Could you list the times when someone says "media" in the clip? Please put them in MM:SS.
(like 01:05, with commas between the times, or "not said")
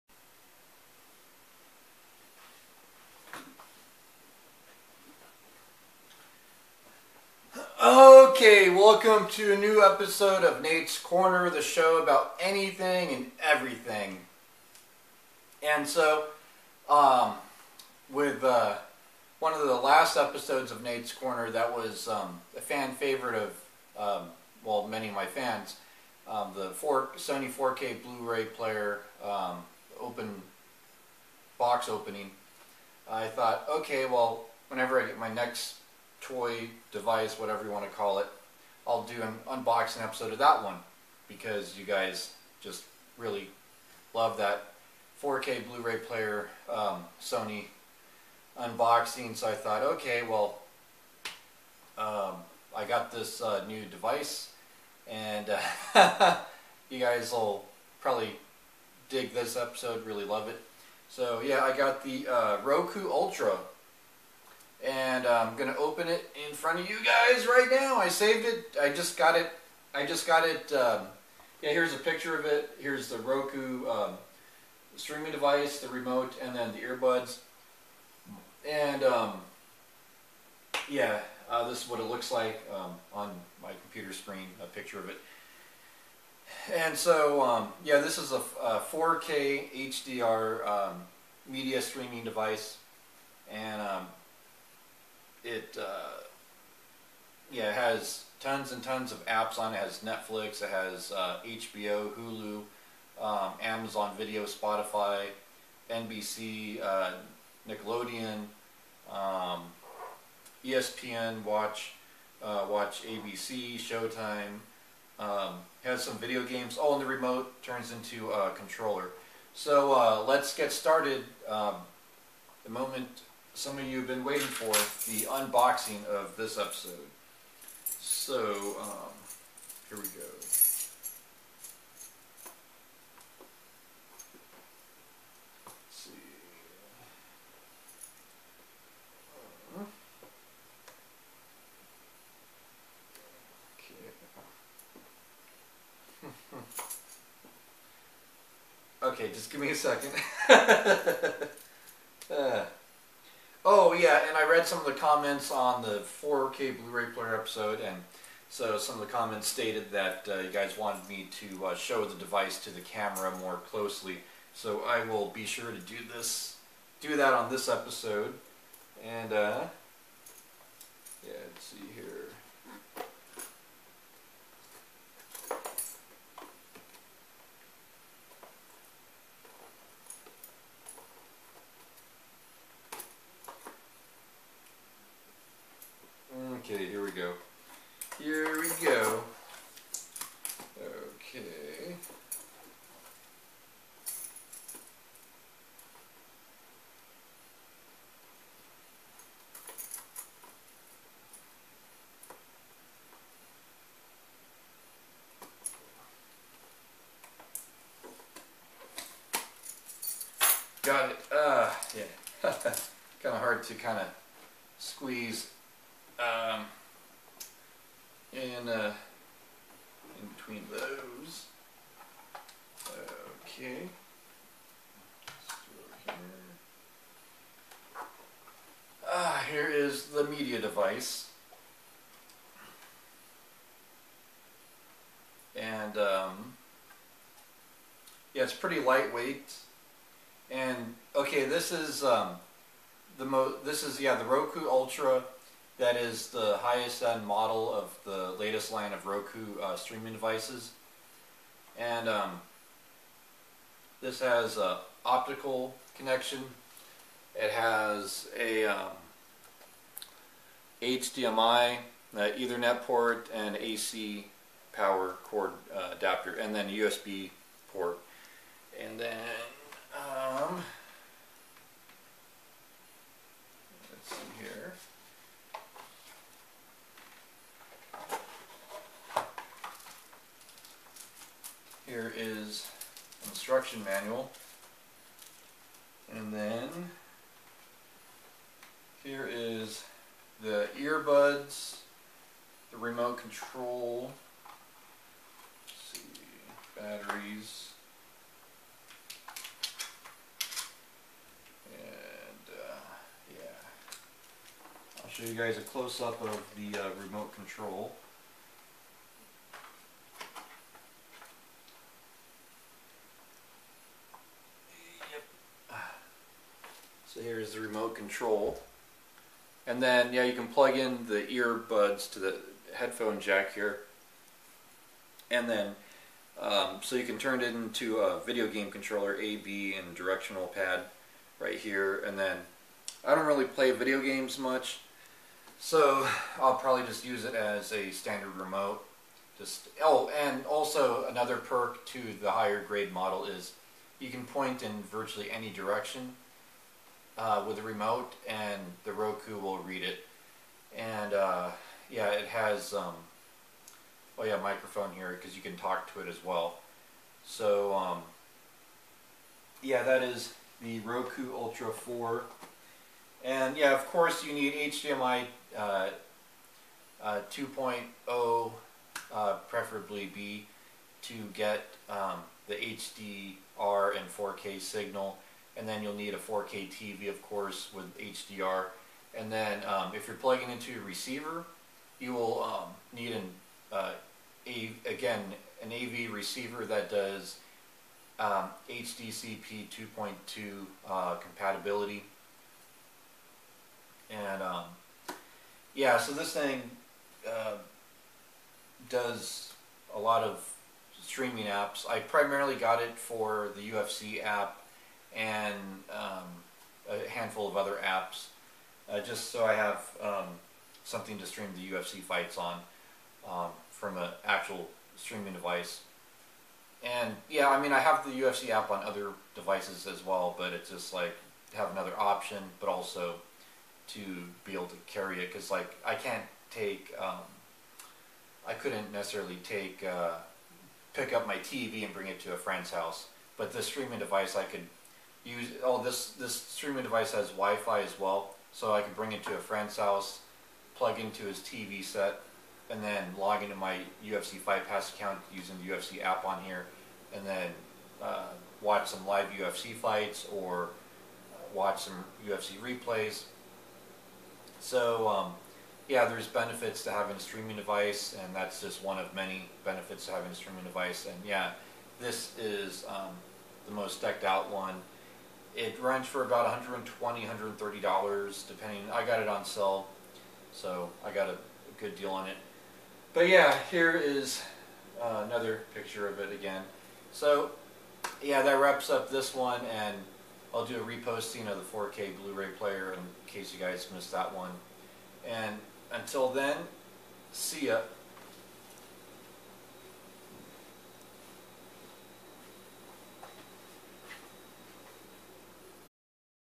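01:31, 03:50.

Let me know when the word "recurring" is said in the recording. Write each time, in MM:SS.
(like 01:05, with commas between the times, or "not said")
not said.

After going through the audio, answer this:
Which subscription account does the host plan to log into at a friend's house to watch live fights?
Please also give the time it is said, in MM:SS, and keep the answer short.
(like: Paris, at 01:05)
UFC Fight Pass, at 07:24.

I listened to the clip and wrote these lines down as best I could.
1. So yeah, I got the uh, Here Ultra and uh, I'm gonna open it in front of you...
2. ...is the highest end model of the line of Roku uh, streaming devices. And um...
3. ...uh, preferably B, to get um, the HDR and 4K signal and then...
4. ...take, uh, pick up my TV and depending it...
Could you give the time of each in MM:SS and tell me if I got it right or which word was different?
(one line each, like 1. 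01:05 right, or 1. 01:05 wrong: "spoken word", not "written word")
1. 01:01 wrong: "Roku", not "Here"
2. 04:05 right
3. 06:09 right
4. 07:09 wrong: "bring", not "depending".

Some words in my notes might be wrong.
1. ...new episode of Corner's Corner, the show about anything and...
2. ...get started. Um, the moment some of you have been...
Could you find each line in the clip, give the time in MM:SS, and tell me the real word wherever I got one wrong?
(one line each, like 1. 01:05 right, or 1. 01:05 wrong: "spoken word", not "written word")
1. 00:09 wrong: "Nate", not "Corner"
2. 02:00 right.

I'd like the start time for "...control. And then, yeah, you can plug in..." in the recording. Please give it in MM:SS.
05:17.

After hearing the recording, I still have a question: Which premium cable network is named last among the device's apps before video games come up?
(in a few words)
Showtime.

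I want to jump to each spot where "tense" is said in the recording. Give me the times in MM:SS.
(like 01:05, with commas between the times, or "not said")
not said.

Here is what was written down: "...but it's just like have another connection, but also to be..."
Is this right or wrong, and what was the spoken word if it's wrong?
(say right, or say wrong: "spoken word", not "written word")
wrong: "option", not "connection".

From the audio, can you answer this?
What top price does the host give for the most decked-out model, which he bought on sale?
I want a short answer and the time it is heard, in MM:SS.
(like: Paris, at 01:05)
$130, at 07:47.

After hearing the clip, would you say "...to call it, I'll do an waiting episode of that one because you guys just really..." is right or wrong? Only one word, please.
wrong.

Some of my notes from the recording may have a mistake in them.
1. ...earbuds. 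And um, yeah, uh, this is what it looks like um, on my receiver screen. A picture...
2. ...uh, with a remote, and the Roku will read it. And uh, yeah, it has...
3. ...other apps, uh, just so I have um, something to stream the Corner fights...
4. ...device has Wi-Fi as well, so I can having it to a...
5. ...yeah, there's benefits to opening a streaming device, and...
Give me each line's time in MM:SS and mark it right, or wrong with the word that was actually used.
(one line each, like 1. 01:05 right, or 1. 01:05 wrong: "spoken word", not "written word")
1. 01:16 wrong: "computer", not "receiver"
2. 05:47 right
3. 06:47 wrong: "UFC", not "Corner"
4. 07:16 wrong: "bring", not "having"
5. 07:35 wrong: "having", not "opening".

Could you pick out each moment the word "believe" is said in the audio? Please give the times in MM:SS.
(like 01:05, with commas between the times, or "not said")
not said.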